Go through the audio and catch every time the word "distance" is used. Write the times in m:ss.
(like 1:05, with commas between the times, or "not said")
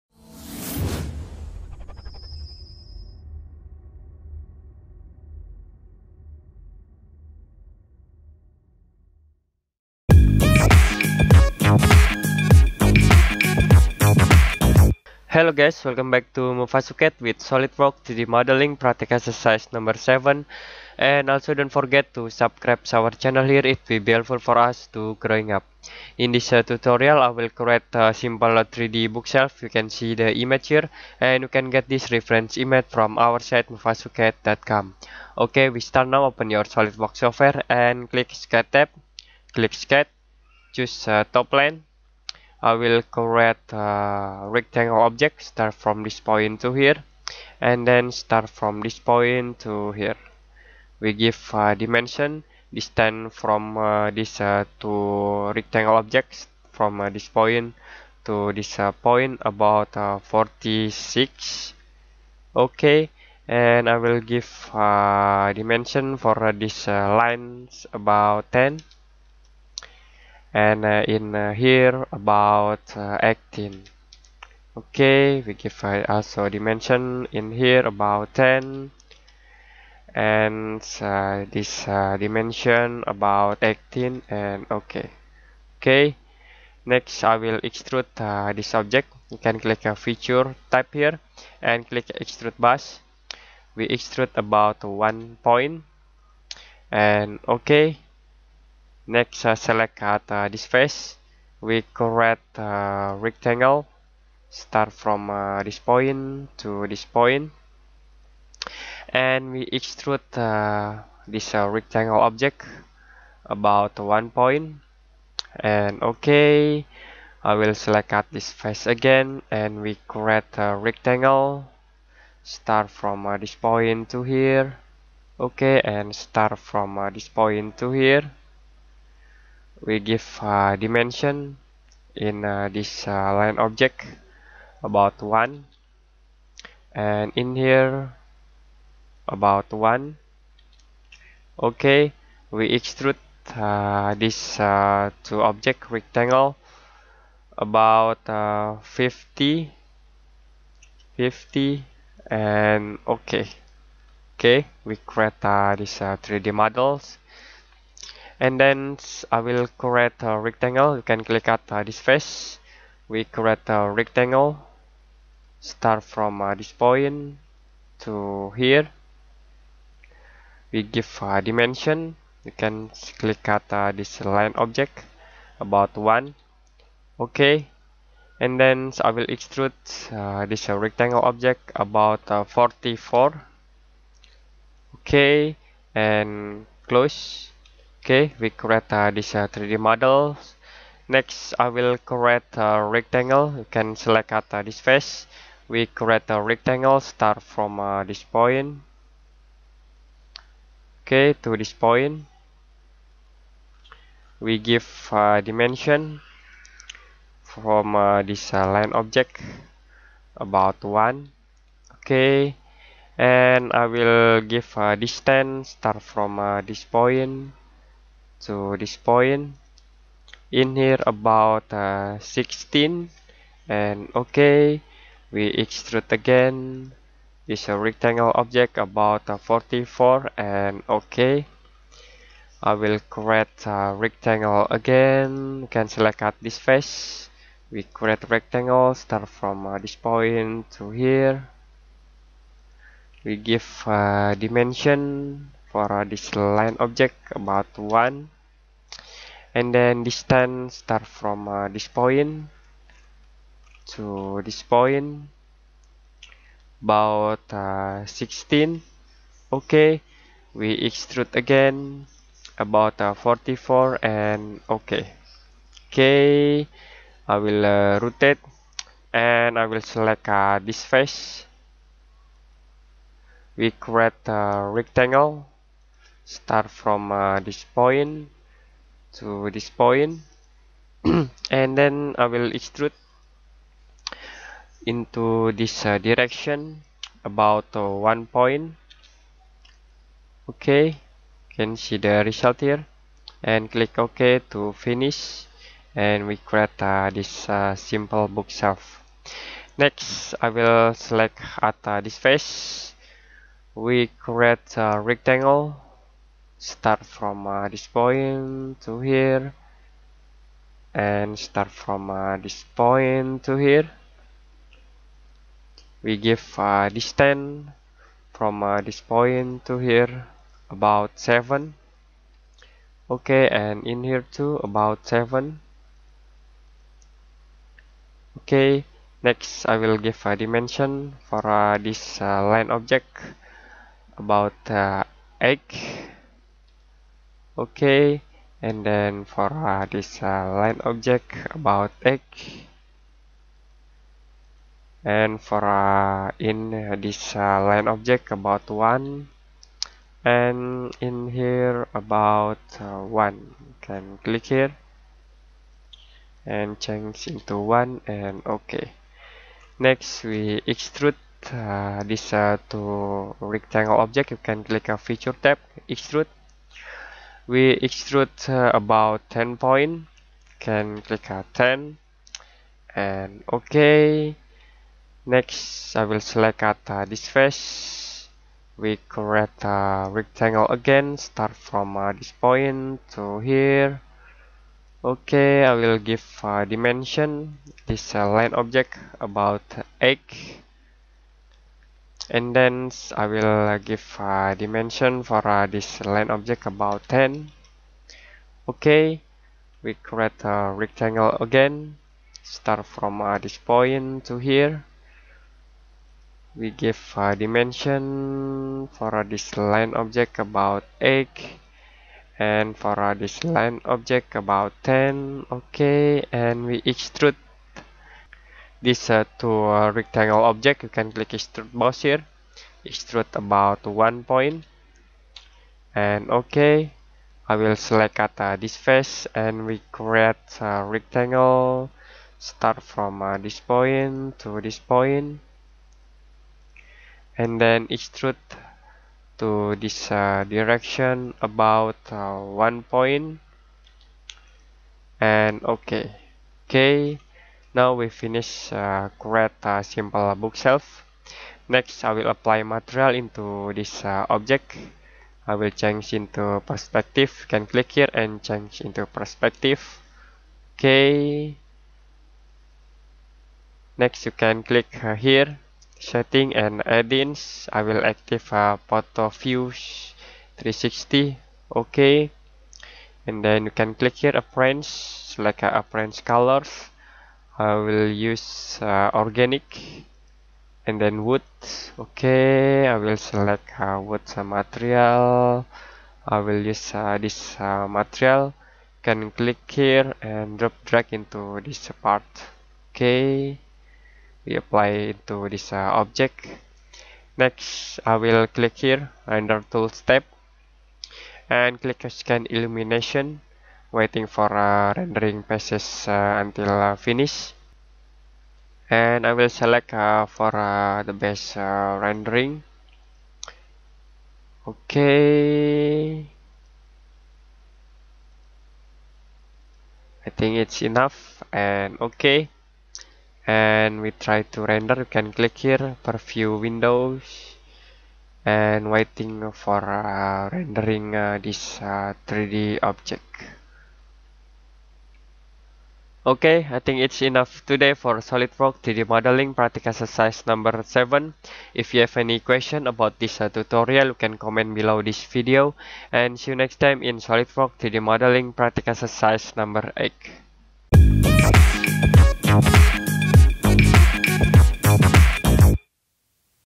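0:52, 3:34, 4:10, 5:16.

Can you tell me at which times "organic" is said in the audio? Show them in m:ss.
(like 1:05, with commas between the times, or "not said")
7:59.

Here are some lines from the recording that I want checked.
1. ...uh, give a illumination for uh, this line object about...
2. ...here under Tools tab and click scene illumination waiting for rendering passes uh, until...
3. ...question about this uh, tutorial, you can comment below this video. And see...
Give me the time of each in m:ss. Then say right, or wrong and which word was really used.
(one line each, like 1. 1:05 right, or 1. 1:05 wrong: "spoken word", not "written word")
1. 6:33 wrong: "dimension", not "illumination"
2. 8:18 right
3. 9:02 right.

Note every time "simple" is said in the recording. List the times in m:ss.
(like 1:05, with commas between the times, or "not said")
0:28, 4:57, 7:29.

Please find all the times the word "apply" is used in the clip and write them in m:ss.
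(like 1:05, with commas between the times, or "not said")
7:32, 8:14.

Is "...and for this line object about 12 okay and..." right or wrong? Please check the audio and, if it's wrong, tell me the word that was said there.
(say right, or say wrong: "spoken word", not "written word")
wrong: "10", not "12".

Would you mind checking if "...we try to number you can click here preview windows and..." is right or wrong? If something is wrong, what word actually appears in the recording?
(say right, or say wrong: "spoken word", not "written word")
wrong: "render", not "number".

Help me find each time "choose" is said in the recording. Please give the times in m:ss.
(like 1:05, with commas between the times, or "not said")
0:40.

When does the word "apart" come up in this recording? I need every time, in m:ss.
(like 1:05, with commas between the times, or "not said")
not said.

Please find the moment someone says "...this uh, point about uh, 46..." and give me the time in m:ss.
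0:58.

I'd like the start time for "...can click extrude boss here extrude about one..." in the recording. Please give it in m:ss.
7:00.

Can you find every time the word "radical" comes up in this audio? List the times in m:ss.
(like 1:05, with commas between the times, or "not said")
not said.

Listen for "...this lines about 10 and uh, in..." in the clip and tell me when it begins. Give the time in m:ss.
1:06.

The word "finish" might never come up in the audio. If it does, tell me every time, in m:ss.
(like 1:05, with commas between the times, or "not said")
4:54, 7:28, 8:26.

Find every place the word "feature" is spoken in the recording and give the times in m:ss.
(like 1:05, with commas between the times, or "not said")
1:29, 6:04.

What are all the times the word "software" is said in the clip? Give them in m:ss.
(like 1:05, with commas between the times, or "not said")
0:37.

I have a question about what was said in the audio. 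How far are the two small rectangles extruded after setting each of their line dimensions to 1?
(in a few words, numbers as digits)
50.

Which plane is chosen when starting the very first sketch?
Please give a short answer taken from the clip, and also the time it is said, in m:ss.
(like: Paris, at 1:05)
top plane, at 0:41.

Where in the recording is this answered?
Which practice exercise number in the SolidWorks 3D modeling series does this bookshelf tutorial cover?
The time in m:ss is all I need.
0:18.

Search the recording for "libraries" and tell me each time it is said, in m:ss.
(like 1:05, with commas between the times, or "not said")
not said.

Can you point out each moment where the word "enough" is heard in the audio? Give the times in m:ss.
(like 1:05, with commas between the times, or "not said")
8:40, 8:57.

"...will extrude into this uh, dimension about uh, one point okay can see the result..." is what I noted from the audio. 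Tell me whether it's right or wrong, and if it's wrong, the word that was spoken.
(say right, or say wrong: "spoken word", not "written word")
wrong: "direction", not "dimension".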